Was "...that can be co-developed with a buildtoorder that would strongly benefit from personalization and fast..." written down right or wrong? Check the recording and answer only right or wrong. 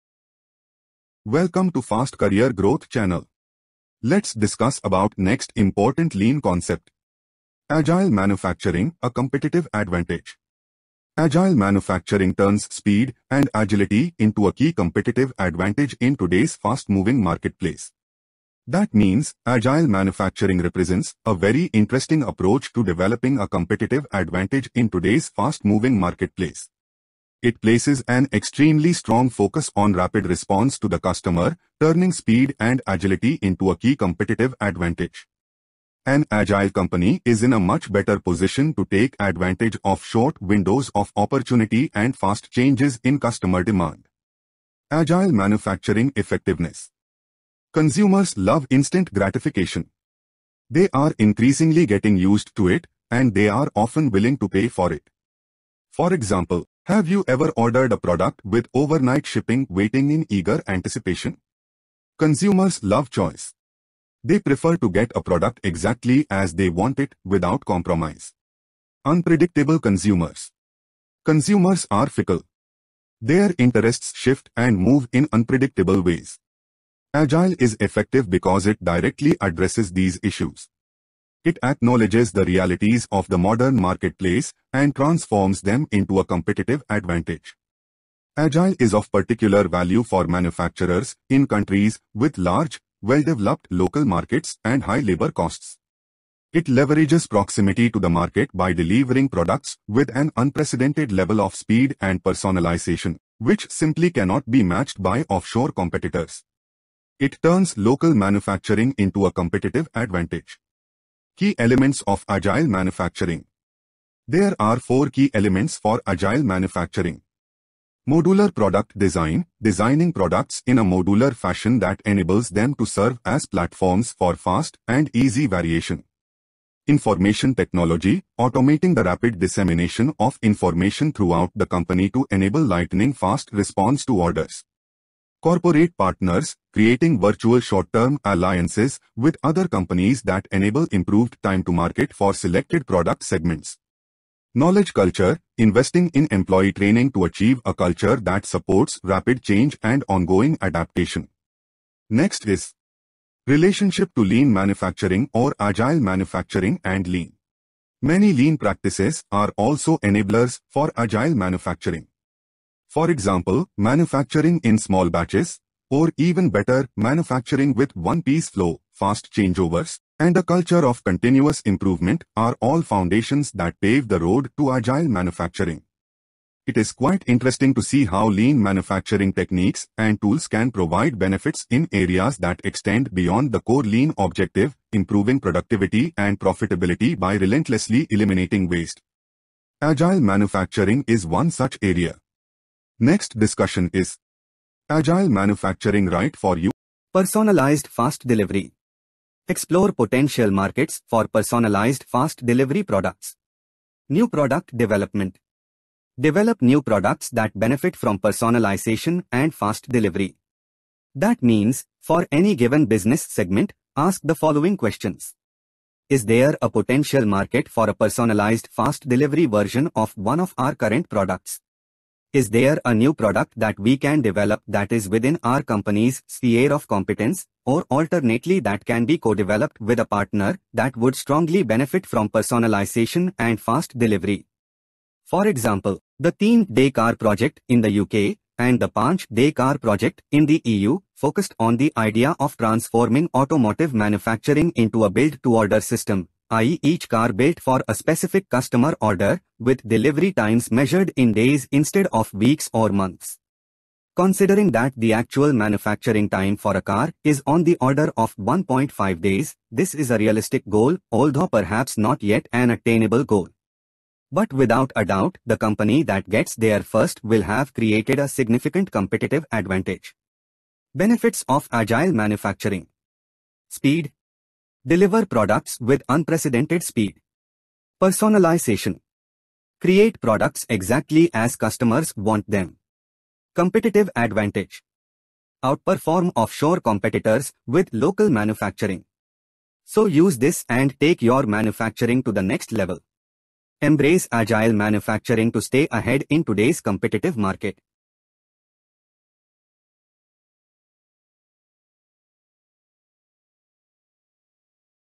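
wrong.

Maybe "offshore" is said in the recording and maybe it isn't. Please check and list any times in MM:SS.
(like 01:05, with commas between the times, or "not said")
01:45, 04:46.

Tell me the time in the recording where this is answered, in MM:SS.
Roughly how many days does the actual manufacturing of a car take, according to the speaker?
04:18.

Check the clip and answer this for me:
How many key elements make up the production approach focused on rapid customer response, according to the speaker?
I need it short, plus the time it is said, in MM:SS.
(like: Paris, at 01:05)
4, at 01:54.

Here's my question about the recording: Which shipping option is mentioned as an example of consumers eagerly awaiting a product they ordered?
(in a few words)
Overnight shipping.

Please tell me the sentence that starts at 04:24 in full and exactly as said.
But without a doubt, the company that gets there first will have created a significant competitive advantage.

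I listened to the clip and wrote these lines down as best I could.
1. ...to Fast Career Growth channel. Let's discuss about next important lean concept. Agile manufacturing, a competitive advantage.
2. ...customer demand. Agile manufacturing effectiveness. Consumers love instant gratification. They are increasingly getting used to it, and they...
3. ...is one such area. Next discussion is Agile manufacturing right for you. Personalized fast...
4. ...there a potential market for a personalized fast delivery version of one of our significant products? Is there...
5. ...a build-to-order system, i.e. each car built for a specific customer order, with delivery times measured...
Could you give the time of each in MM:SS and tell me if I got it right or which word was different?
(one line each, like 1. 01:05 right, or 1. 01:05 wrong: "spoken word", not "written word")
1. 00:01 right
2. 00:43 right
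3. 03:11 right
4. 03:36 wrong: "current", not "significant"
5. 04:05 right.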